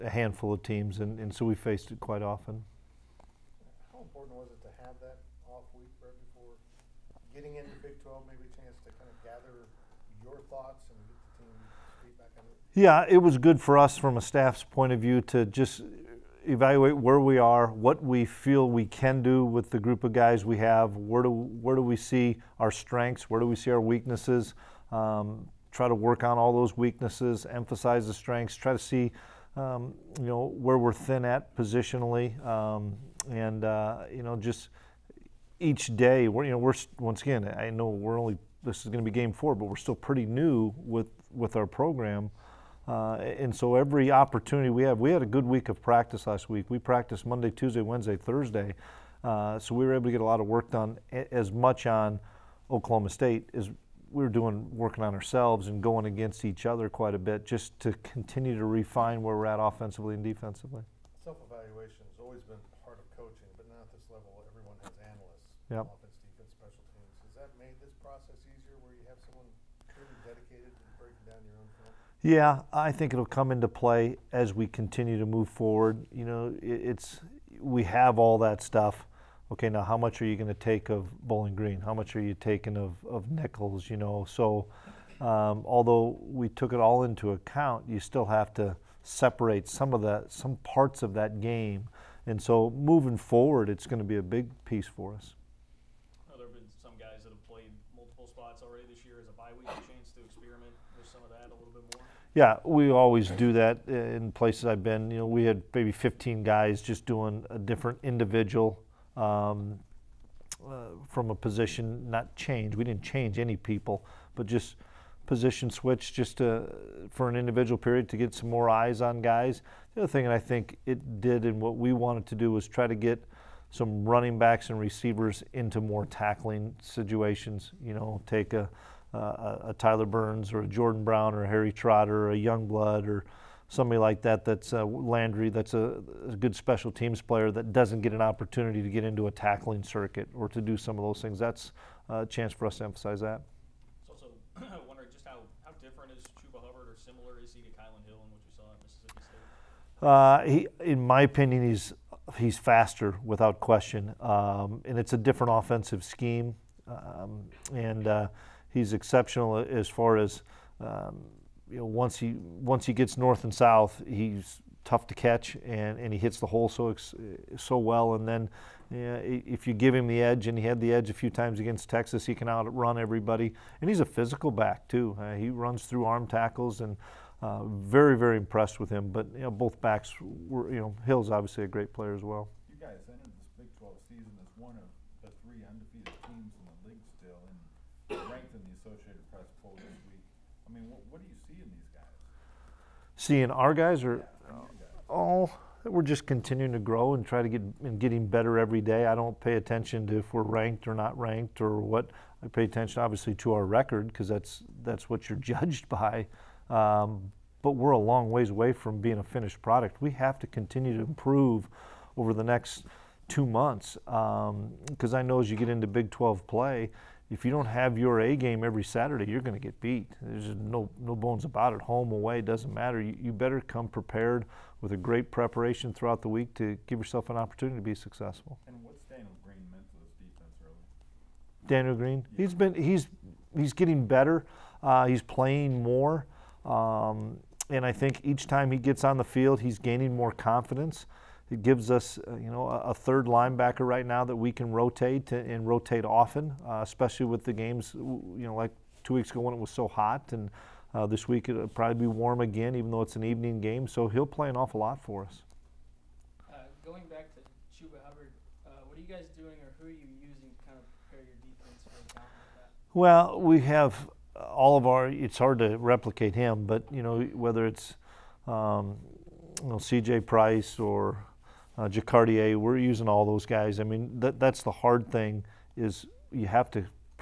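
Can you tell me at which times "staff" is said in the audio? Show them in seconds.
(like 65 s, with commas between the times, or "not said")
14 s.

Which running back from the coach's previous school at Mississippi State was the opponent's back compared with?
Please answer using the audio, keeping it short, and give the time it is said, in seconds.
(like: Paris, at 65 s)
Kylan Hill, at 147 s.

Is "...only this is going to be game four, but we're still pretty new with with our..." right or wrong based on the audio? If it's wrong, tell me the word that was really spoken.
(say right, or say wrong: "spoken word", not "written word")
right.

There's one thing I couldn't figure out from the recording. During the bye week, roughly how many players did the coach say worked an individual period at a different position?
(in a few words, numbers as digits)
15.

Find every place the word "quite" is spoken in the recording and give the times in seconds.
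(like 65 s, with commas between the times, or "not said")
1 s, 56 s.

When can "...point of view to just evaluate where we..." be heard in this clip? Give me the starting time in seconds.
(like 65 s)
14 s.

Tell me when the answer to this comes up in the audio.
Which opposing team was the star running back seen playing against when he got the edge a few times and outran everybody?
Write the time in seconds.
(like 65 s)
171 s.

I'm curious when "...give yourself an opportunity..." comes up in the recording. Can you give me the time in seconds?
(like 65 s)
226 s.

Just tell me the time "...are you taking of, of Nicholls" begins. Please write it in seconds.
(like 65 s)
82 s.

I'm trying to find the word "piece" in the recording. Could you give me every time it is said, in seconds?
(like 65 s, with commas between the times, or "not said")
94 s.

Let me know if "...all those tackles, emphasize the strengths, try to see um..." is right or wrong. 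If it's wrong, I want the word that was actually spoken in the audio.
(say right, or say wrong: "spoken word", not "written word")
wrong: "weaknesses", not "tackles".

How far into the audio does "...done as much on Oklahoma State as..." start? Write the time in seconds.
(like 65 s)
50 s.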